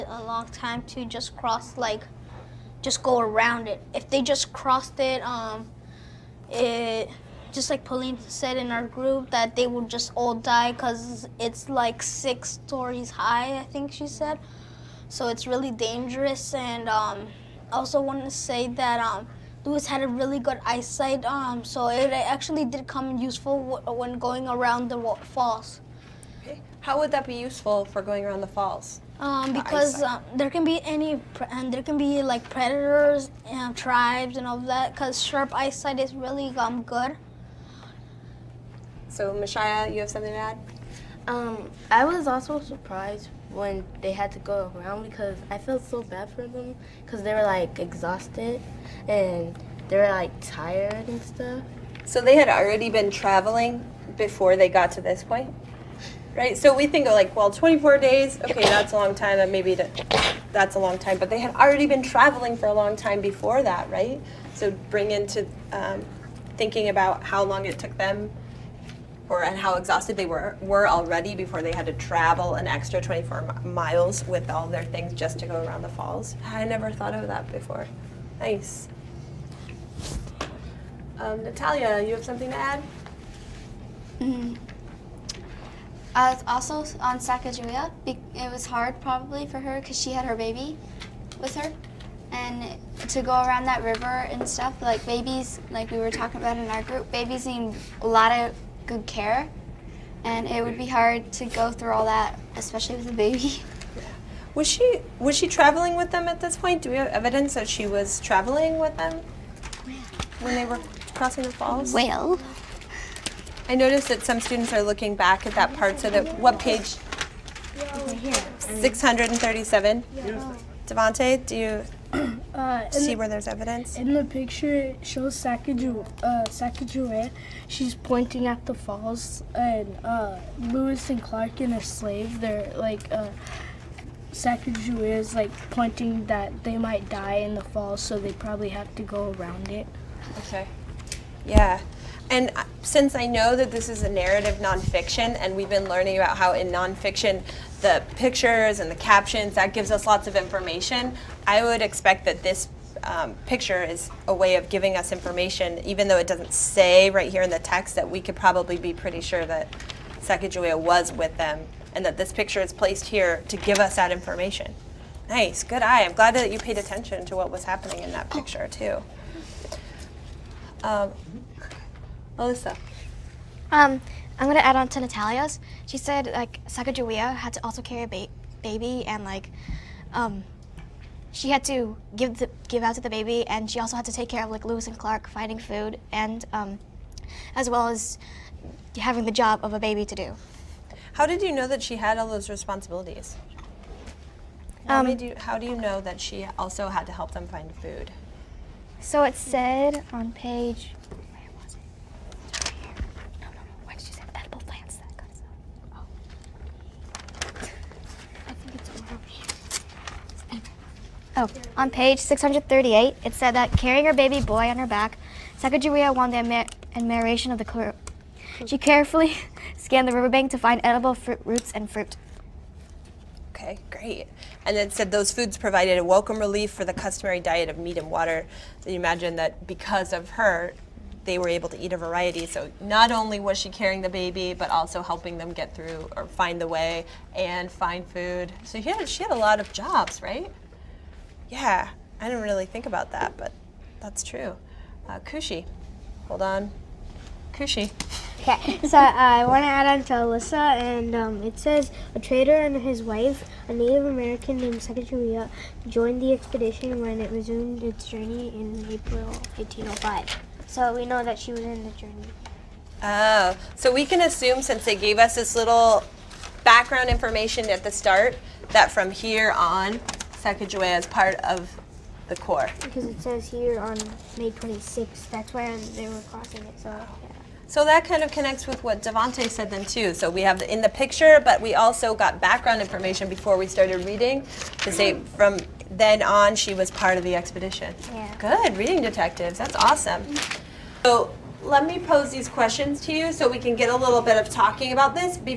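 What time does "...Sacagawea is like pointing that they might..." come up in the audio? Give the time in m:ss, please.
2:14.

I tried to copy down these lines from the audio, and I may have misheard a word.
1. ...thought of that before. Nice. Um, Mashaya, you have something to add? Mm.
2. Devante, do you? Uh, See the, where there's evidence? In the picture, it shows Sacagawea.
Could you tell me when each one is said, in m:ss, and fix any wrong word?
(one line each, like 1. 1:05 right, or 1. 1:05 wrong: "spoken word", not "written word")
1. 1:16 wrong: "Natalia", not "Mashaya"
2. 2:00 right.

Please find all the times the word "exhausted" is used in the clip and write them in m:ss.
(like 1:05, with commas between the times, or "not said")
0:47, 1:09.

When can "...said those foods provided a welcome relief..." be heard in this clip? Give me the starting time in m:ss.
3:44.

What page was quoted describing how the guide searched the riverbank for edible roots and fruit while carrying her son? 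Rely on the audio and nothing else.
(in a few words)
638.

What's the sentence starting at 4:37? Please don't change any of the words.
So that kind of connects with what Devante said then too.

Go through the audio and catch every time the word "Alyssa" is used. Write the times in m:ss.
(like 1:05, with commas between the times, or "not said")
2:52, 4:10.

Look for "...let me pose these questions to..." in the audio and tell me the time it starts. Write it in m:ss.
4:51.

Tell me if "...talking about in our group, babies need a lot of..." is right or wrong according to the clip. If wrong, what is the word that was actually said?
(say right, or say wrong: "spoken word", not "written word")
right.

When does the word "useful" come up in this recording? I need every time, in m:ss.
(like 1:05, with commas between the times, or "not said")
0:23, 0:27.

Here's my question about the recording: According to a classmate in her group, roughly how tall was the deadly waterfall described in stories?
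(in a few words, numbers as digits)
6 stories.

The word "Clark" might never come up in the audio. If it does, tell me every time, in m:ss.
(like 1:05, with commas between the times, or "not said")
2:11, 3:04.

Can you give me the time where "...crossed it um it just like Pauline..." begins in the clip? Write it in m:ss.
0:04.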